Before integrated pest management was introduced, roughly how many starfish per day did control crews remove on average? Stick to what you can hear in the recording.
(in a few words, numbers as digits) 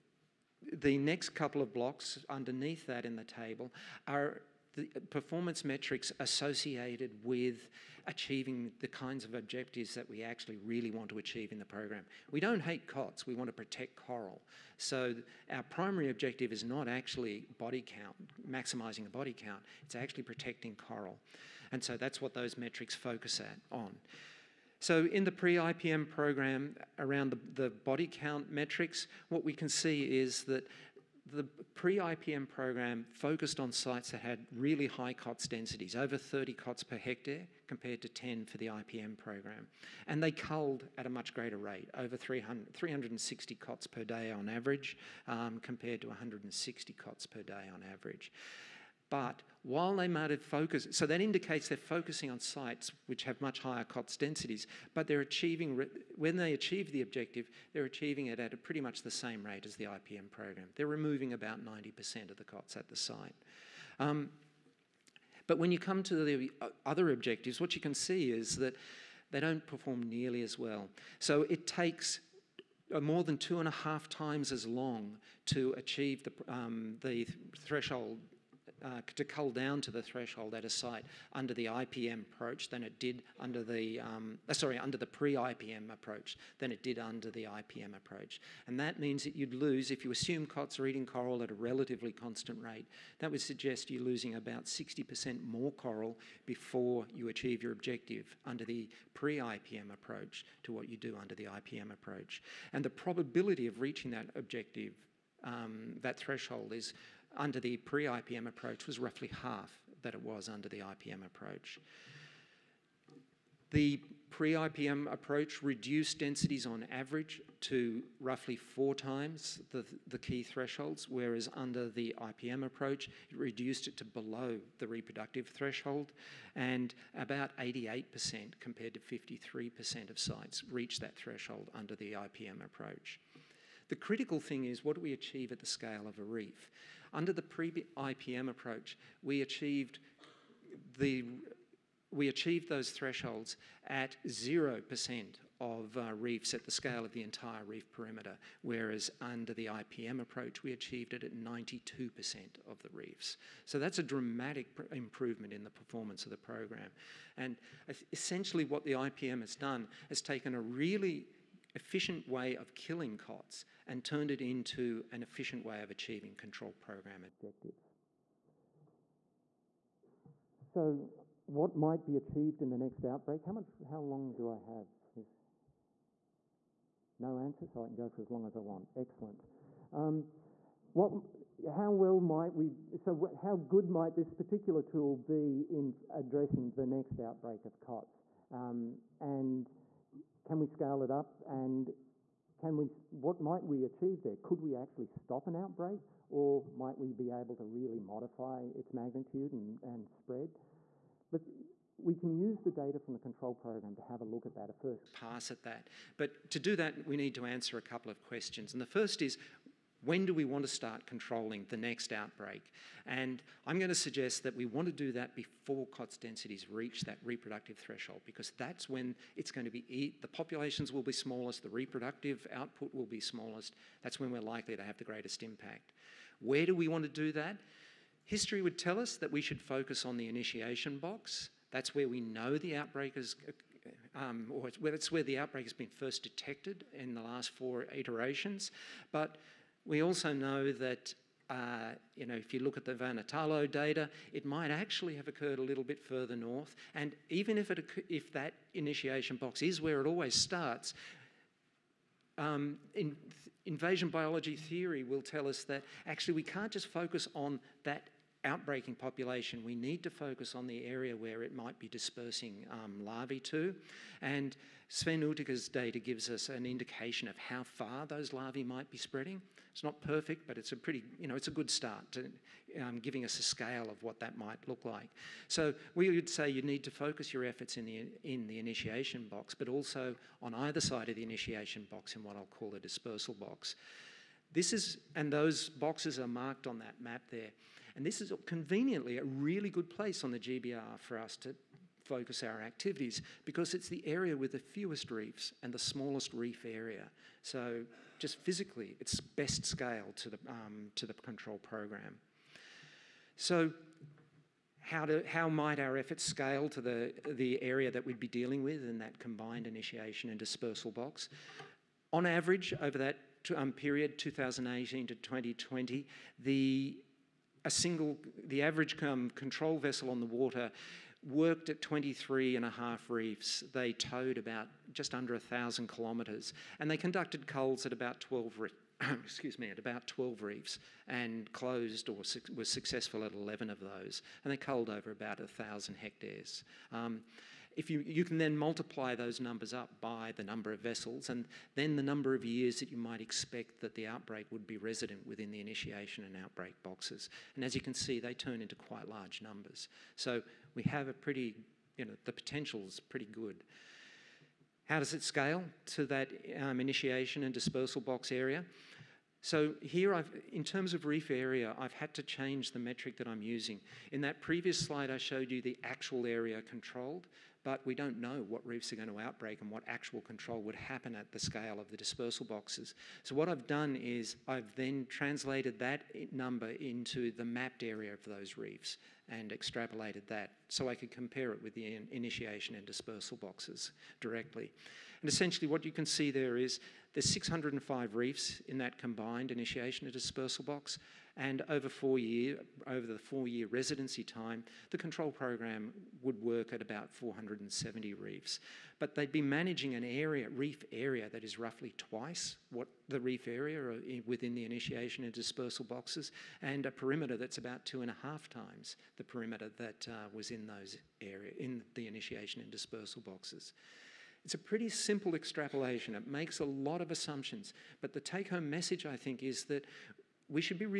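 360.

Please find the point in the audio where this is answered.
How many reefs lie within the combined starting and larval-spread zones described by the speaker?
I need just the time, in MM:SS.
06:27.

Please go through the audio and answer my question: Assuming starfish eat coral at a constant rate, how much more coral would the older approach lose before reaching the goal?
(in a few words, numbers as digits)
60%.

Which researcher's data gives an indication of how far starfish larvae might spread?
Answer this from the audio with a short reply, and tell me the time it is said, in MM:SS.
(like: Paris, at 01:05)
Sven Uthicke, at 04:24.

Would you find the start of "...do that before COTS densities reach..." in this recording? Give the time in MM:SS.
03:34.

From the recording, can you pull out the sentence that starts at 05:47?
And as you can see, they turn into quite large numbers.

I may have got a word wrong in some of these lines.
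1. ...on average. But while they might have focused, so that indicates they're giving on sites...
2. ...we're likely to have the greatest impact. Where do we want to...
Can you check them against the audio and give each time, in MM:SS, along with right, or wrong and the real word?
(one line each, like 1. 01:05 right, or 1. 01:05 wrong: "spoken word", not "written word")
1. 00:47 wrong: "focusing", not "giving"
2. 03:44 right.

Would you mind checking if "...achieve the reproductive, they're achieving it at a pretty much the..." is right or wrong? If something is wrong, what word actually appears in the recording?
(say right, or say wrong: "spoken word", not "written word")
wrong: "objective", not "reproductive".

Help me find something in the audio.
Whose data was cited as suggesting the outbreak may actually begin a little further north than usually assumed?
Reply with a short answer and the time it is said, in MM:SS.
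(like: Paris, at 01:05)
Vanhatalo, at 04:02.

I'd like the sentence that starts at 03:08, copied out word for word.
Um, and can we scale it up and can we, what might we achieve there?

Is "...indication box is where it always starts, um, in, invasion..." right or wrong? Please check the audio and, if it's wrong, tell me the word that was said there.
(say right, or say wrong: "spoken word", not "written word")
wrong: "initiation", not "indication".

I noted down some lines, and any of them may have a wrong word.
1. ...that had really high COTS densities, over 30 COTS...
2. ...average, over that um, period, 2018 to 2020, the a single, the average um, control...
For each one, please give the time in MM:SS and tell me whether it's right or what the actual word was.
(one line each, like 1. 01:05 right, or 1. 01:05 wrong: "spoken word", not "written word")
1. 00:34 right
2. 05:12 right.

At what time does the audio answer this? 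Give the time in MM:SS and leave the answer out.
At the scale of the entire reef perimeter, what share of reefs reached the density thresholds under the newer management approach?
02:31.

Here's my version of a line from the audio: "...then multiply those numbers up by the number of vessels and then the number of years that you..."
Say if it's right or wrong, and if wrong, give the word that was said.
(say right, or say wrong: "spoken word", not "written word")
right.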